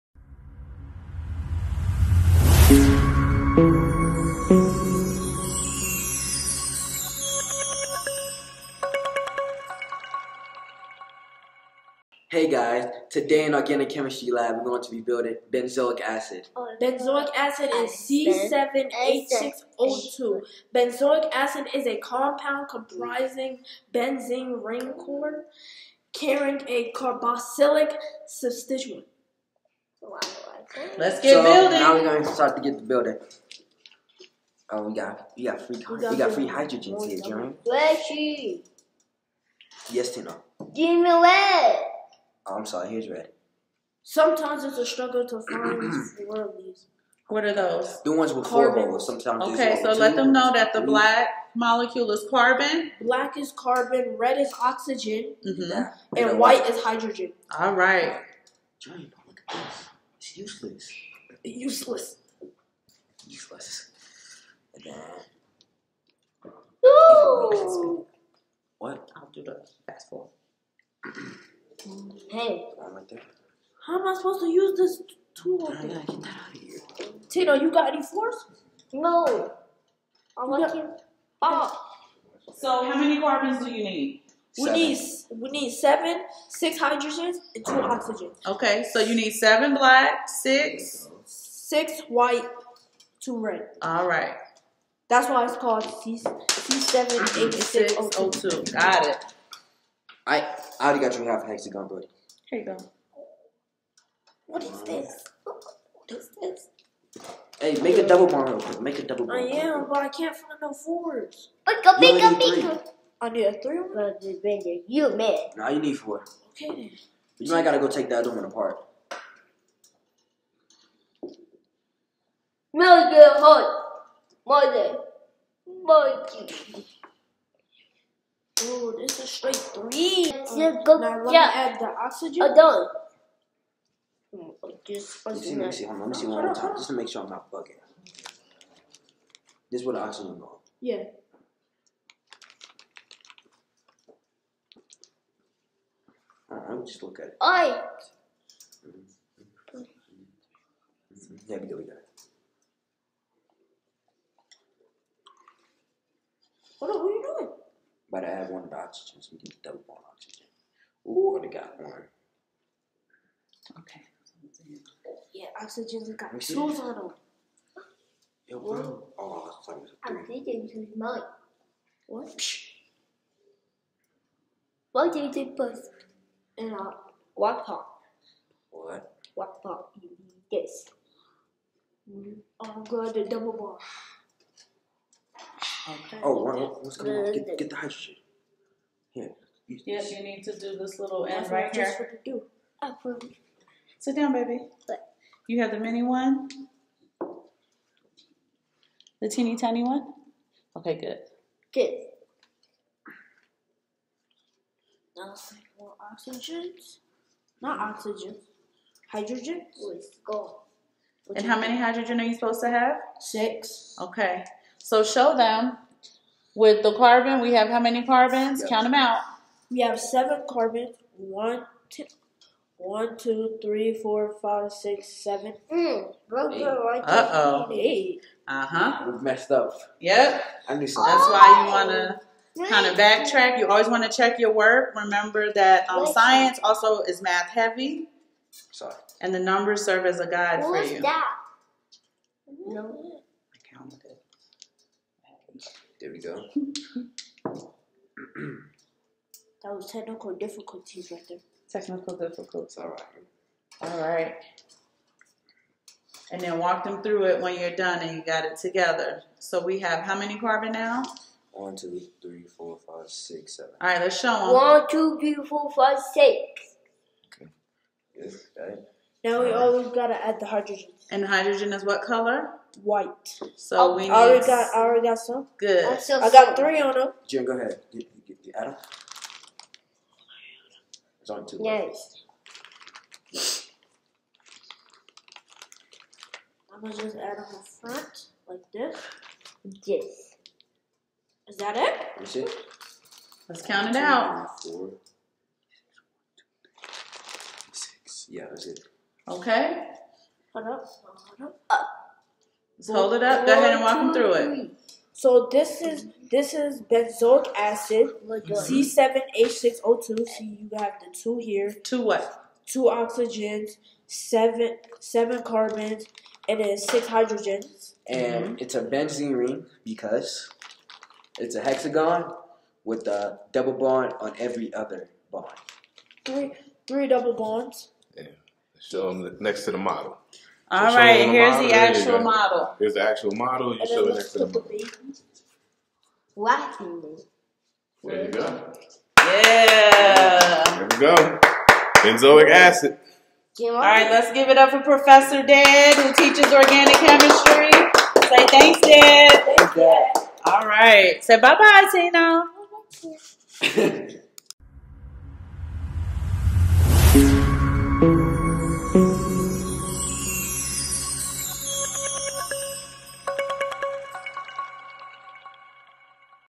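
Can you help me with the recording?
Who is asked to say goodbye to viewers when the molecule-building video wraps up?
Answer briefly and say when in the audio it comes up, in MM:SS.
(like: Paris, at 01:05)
Tino, at 05:53.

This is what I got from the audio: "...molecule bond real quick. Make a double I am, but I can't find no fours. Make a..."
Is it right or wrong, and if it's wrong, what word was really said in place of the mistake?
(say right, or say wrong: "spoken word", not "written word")
wrong: "double", not "molecule".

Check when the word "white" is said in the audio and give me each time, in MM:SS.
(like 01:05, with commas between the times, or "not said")
00:56, 01:32, 04:32.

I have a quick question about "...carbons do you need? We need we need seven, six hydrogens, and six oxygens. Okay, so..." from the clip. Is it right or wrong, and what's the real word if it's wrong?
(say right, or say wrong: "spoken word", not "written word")
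wrong: "two", not "six".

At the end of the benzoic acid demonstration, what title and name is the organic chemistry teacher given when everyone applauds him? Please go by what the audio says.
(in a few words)
Professor Dad.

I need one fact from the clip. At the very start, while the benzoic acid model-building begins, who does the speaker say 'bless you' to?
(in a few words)
Jeremy.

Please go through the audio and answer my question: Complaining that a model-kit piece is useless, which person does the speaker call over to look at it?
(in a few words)
Johnny.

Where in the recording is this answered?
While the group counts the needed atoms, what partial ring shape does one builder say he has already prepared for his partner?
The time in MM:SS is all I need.
01:41.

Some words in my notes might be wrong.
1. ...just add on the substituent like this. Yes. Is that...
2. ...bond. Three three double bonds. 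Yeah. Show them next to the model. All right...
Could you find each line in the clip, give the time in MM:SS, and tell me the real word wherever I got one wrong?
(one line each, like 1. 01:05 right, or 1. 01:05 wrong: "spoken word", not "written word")
1. 04:47 wrong: "front", not "substituent"
2. 05:25 right.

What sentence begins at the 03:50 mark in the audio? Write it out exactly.
I knew That's why you wanna kind of backtrack.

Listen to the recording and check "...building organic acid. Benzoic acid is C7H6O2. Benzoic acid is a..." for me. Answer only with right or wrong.
wrong.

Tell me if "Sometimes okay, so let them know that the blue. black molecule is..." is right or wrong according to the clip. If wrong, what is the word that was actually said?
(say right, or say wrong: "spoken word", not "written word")
right.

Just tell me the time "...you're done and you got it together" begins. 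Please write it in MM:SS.
04:17.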